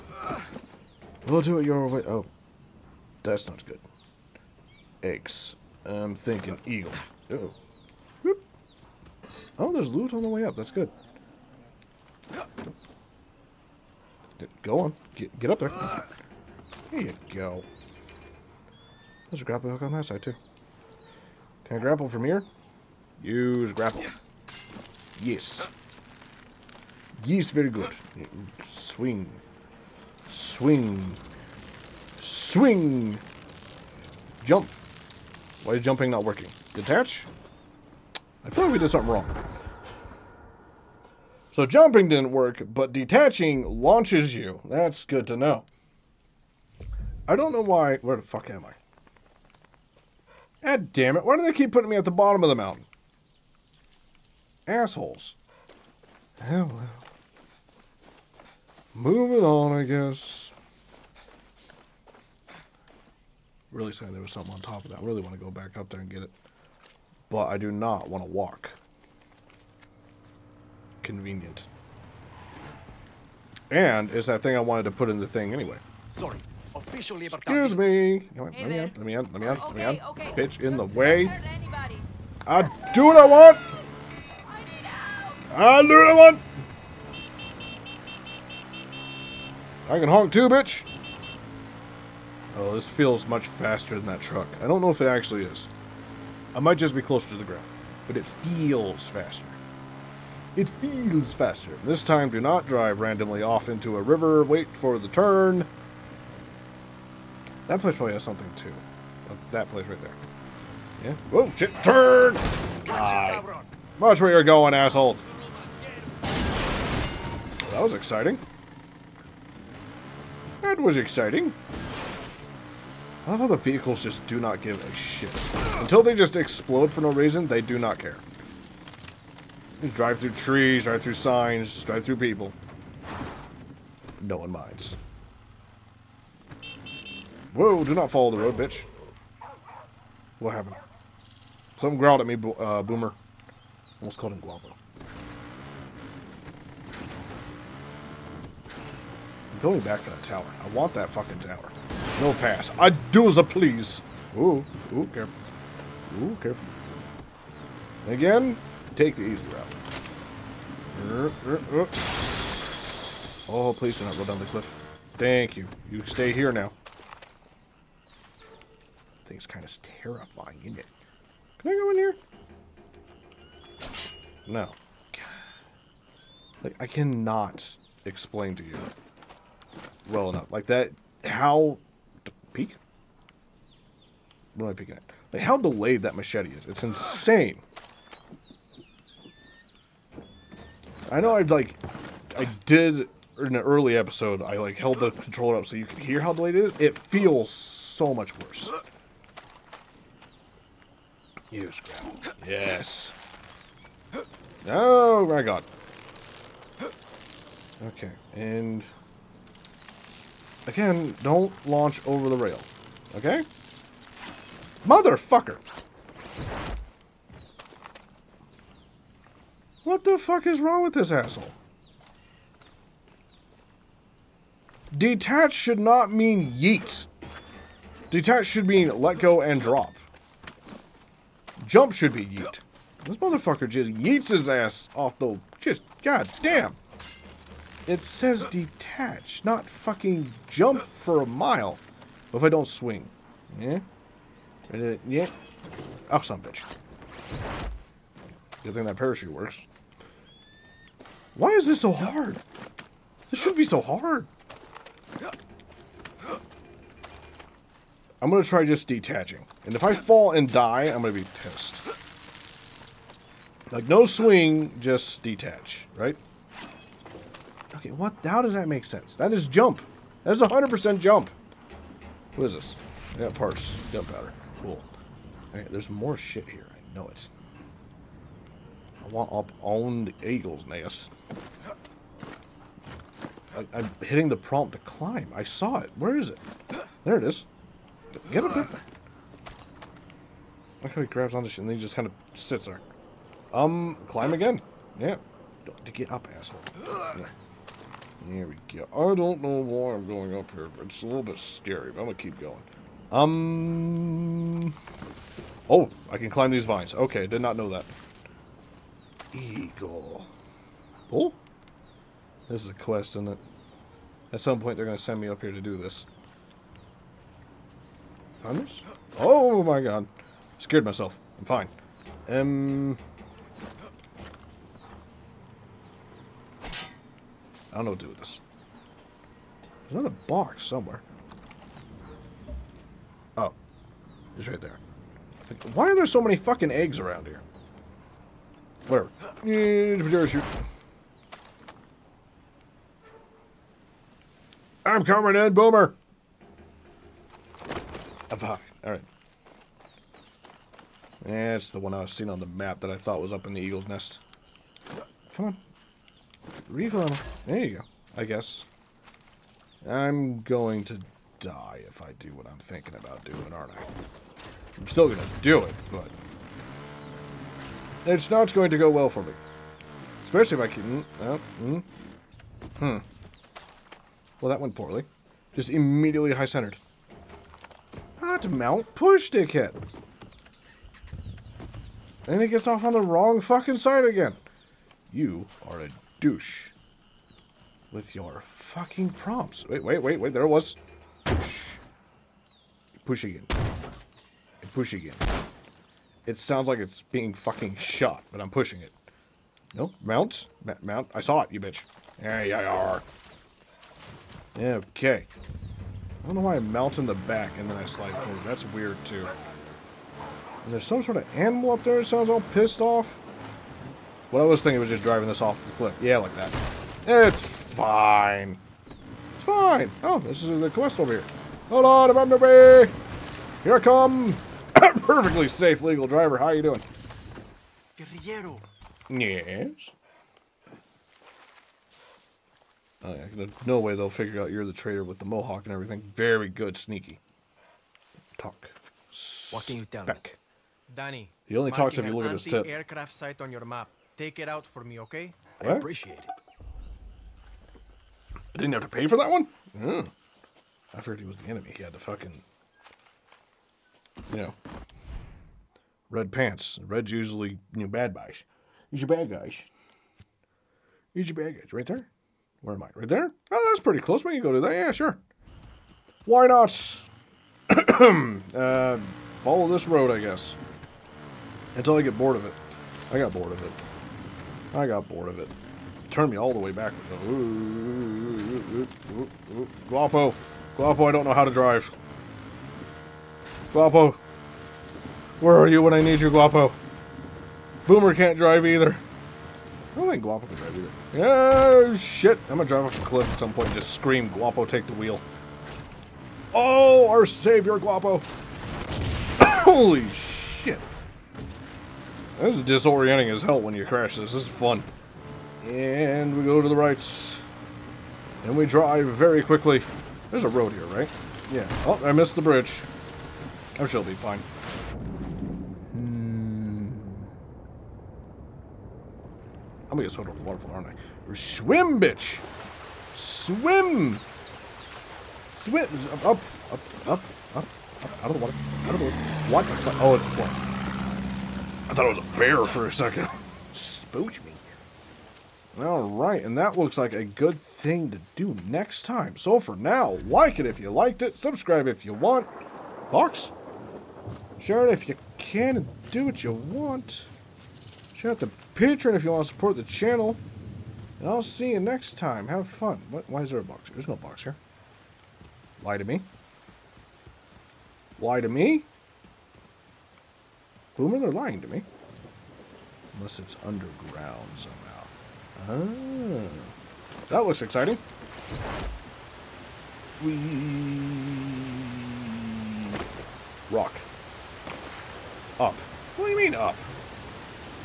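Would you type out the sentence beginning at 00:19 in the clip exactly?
There's a grapple hook on that side, too.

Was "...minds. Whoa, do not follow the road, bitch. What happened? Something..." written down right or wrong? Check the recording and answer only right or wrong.
right.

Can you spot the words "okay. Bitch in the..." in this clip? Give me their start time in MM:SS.
01:20.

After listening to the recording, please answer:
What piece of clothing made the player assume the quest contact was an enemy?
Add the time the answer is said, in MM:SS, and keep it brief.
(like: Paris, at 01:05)
Red pants, at 07:36.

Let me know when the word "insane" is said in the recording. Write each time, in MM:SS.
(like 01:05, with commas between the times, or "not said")
03:06.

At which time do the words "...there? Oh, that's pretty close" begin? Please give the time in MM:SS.
07:43.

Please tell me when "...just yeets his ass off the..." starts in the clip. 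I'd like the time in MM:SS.
03:53.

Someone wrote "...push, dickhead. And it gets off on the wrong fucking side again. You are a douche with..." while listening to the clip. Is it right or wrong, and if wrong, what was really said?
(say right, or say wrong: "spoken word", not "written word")
right.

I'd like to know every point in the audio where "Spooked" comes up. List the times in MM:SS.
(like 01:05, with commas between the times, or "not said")
08:53.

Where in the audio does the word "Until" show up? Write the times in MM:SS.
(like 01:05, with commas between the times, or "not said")
02:05, 07:51.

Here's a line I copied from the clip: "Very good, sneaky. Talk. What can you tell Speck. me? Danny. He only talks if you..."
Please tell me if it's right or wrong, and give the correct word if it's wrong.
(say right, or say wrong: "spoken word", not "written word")
right.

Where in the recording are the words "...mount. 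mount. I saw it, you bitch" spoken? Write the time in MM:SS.
06:40.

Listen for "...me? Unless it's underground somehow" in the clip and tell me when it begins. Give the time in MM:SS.
09:21.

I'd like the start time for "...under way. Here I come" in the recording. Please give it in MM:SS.
07:02.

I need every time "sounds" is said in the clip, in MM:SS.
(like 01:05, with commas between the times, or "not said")
06:36, 06:52.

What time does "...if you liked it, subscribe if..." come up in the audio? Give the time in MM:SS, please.
09:00.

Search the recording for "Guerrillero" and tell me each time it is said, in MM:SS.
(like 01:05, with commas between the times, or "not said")
07:07.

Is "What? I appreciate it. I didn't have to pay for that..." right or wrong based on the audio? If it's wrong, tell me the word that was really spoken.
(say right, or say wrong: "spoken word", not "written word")
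right.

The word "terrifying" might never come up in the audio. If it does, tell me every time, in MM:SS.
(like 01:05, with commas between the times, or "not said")
02:50.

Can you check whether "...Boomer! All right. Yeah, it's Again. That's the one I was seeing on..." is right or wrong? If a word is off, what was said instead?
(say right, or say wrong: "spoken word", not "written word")
wrong: "Alright", not "Again".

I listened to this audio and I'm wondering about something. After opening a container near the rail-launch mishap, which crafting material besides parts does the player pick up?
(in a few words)
Gunpowder.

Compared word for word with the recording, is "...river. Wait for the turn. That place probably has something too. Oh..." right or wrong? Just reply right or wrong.
right.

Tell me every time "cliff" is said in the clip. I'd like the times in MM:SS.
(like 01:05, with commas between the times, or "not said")
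02:44, 06:55, 08:13.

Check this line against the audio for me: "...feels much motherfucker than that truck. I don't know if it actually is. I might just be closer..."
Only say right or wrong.
wrong.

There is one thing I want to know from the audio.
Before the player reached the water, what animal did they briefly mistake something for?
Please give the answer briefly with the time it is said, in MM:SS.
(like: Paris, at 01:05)
Bear, at 08:51.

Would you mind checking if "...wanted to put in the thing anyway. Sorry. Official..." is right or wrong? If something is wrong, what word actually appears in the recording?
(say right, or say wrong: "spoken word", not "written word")
right.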